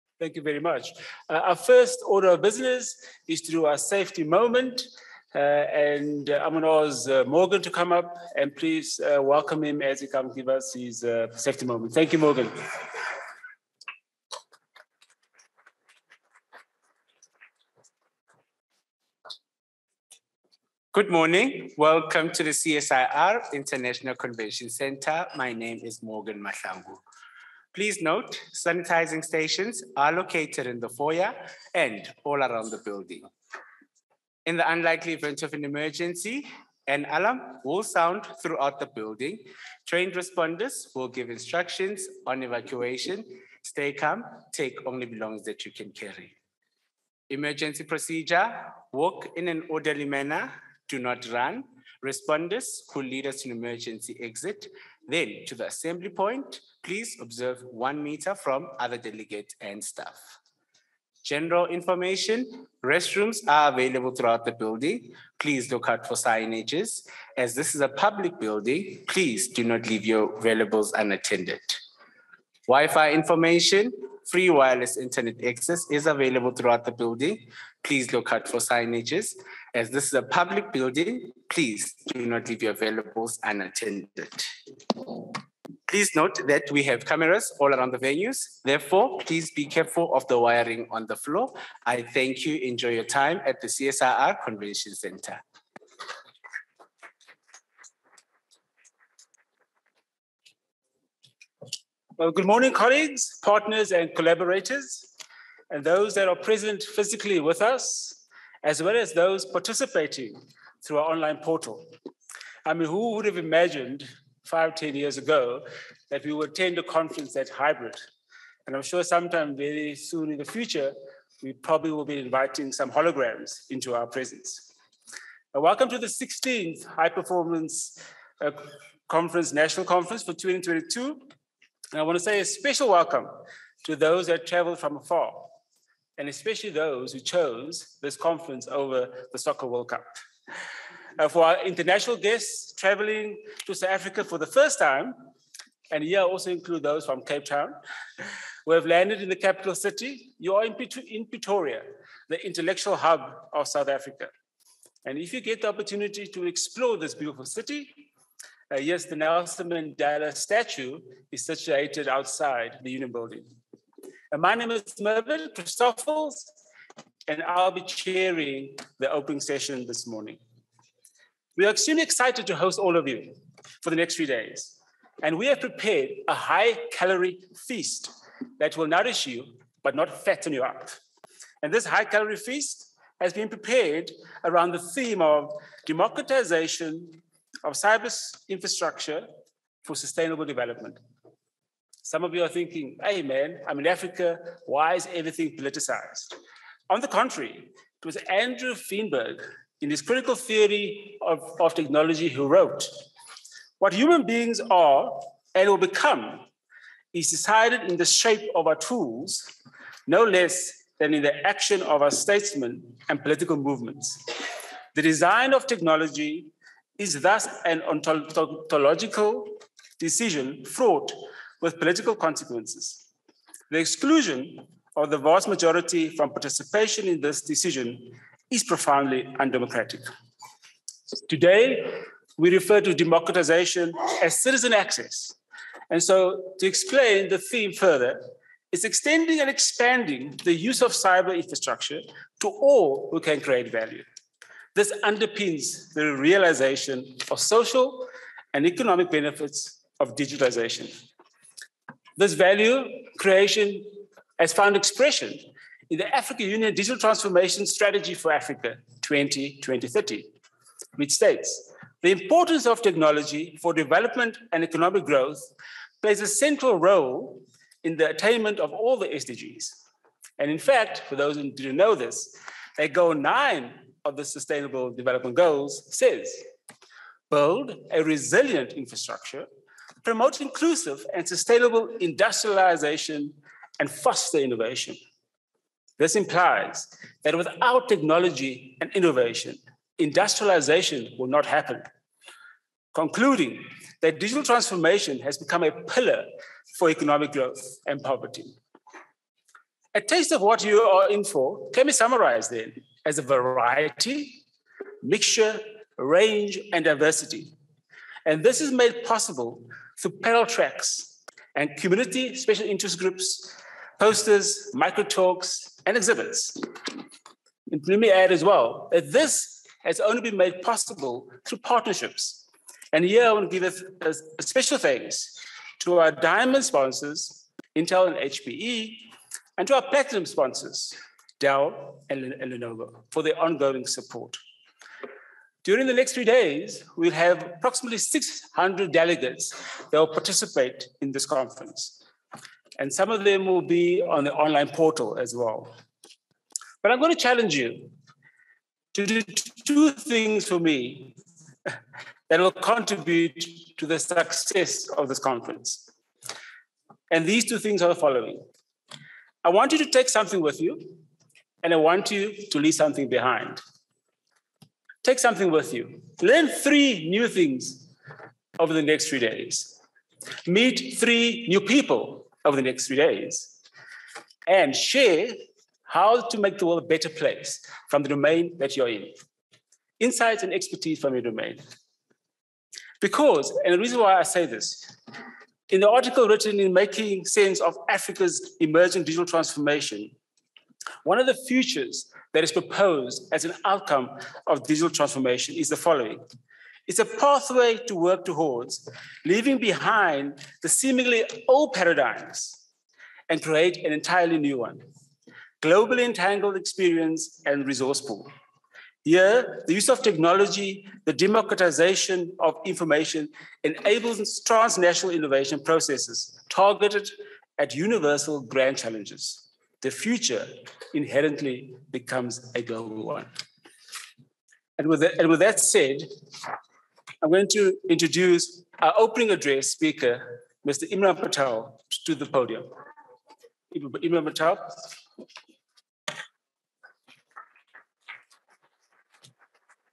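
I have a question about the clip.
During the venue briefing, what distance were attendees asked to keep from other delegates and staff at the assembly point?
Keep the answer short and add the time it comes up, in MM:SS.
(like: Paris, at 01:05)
one meter, at 00:57.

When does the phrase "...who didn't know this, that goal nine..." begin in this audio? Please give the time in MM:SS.
04:31.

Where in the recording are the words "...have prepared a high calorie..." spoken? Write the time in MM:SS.
02:55.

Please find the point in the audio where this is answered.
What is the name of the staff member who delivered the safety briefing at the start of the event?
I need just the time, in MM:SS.
00:26.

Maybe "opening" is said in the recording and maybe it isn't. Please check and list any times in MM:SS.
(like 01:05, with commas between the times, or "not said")
02:49, 07:08.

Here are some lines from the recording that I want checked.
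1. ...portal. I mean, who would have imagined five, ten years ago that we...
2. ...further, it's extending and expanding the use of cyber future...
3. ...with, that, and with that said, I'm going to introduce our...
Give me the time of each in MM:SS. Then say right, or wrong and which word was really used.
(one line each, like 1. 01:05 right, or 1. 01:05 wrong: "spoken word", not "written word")
1. 01:51 right
2. 03:57 wrong: "infrastructure", not "future"
3. 07:04 right.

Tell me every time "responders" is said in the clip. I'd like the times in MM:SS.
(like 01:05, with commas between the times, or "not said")
00:40, 00:52.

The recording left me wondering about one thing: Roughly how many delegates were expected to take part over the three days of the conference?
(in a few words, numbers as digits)
600.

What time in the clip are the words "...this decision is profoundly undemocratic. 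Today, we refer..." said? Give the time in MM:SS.
03:47.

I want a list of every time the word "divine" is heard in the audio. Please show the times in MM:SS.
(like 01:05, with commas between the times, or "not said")
not said.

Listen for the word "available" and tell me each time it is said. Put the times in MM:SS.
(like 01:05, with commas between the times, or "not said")
01:03, 01:16.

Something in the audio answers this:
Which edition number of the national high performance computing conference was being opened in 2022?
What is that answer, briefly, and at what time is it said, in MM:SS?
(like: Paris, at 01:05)
16th, at 02:06.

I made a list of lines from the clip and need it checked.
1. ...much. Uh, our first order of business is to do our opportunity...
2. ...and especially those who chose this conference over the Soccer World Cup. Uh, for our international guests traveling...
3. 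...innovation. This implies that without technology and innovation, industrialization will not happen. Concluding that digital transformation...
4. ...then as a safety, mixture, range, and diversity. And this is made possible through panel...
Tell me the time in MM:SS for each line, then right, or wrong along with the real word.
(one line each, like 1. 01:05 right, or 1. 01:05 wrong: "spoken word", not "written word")
1. 00:00 wrong: "safety", not "opportunity"
2. 02:16 right
3. 04:44 right
4. 05:02 wrong: "variety", not "safety".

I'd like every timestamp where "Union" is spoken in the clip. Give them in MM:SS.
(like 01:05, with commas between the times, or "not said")
02:42, 04:16.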